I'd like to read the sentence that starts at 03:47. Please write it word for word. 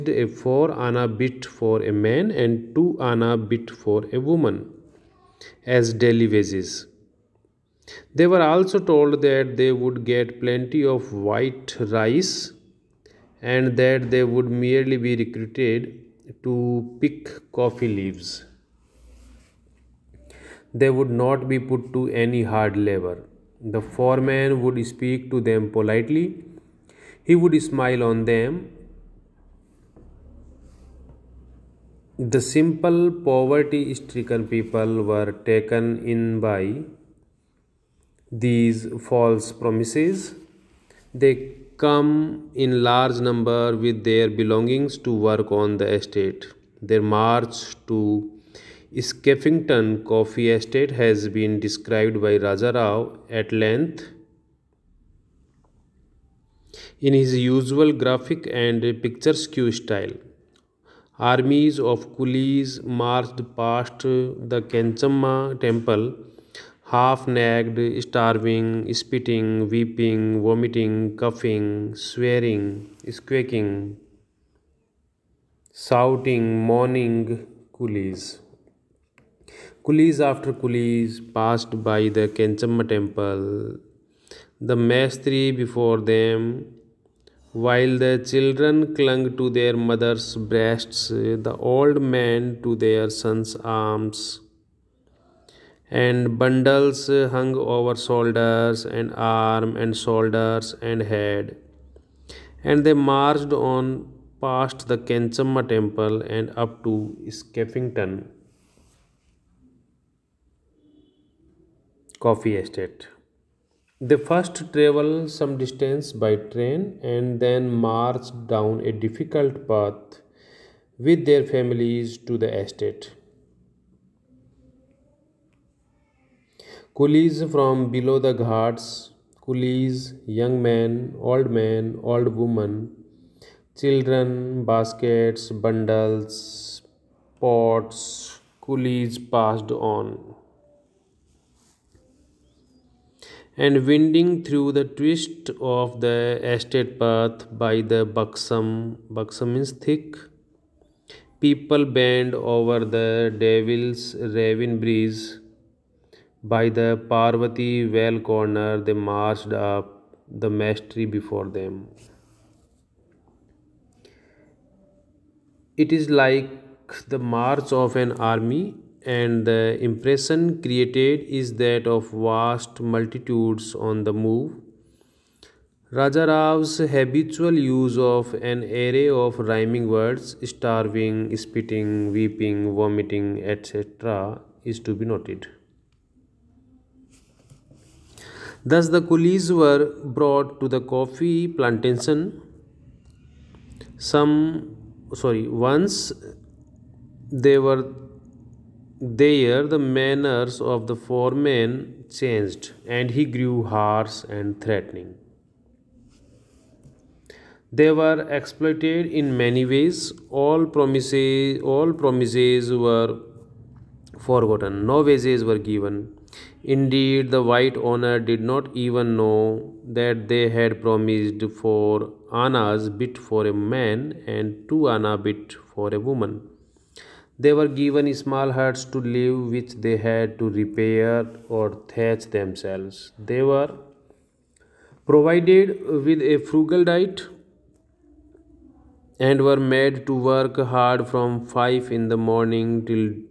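They were given small huts to live which they had to repair or thatch themselves.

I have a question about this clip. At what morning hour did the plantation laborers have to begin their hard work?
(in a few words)
5.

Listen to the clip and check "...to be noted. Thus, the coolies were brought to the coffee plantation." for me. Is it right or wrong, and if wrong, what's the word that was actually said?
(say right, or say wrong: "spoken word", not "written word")
right.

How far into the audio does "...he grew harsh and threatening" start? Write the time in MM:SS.
03:23.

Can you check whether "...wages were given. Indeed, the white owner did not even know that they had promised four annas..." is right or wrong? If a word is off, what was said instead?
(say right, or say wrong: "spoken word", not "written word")
right.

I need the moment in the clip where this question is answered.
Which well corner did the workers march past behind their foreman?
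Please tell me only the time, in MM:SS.
02:37.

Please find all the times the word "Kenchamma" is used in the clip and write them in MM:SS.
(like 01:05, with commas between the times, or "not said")
01:22, 01:45.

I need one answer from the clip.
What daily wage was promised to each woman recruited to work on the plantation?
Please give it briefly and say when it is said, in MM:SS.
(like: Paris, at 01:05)
2 anna bit, at 00:02.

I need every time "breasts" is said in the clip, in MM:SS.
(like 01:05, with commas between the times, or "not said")
01:30.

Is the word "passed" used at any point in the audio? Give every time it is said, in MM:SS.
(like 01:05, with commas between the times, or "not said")
01:21, 02:19.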